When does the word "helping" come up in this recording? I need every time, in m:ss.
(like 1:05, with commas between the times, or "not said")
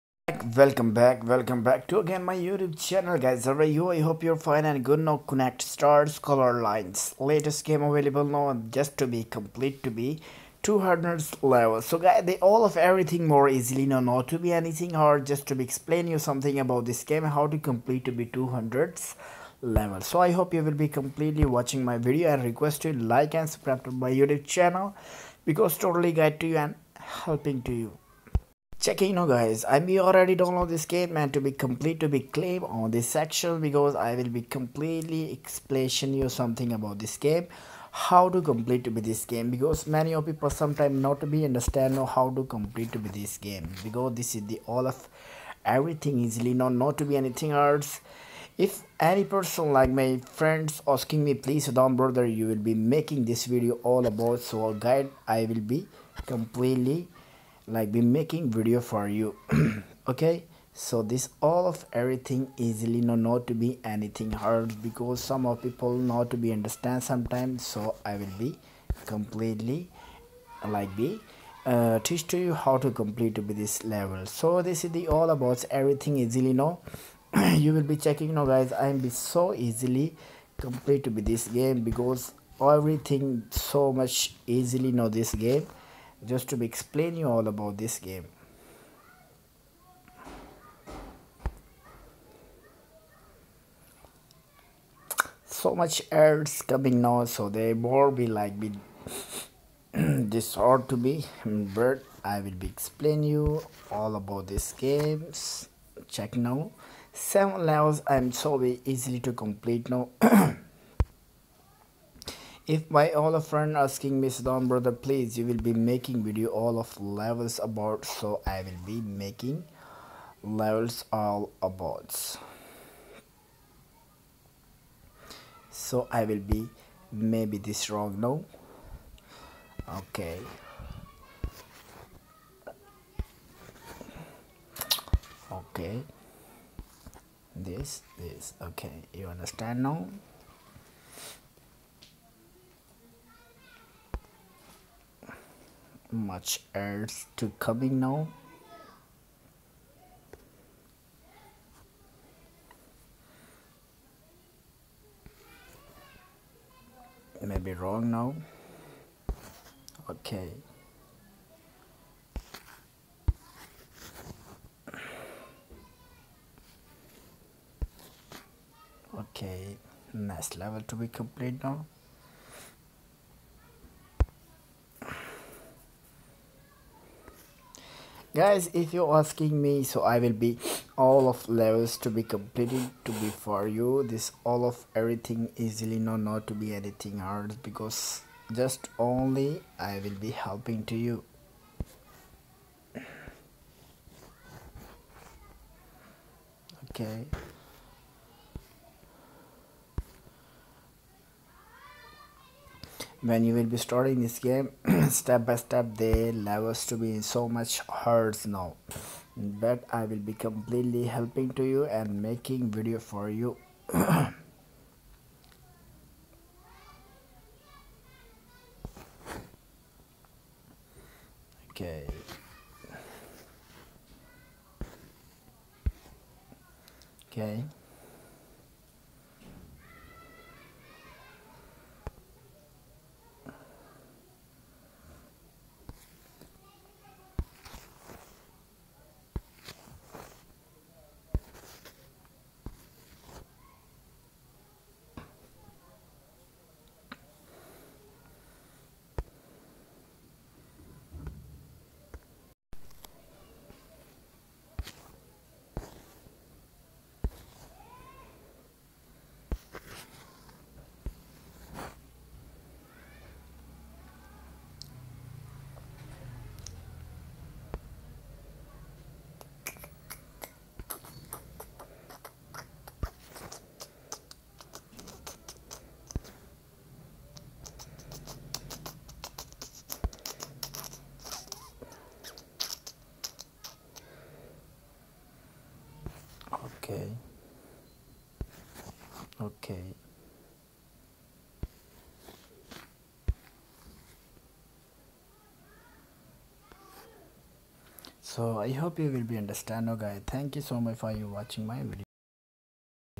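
0:26, 3:10, 3:31.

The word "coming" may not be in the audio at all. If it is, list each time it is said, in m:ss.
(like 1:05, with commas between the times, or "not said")
1:36, 2:27.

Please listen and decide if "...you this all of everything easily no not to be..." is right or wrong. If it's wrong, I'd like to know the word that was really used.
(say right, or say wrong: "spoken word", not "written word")
right.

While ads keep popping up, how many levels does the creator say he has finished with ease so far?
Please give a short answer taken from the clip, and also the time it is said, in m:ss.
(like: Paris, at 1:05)
7, at 1:47.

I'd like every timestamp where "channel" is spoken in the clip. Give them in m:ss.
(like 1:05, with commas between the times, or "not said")
0:02, 0:24.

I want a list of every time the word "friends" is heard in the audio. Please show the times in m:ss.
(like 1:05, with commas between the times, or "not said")
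0:50, 1:53.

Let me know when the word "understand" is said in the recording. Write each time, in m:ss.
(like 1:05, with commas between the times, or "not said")
0:41, 1:06, 2:19, 4:59.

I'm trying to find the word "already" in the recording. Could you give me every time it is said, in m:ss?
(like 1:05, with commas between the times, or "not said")
0:29.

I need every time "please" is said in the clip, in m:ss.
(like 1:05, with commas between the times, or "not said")
0:51, 1:54.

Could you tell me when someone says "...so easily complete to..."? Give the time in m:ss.
1:19.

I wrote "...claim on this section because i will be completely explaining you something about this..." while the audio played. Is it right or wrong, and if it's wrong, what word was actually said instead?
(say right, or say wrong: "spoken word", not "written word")
right.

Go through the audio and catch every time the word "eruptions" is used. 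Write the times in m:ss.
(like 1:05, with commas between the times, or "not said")
not said.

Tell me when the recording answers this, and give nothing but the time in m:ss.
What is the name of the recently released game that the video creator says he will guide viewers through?
0:05.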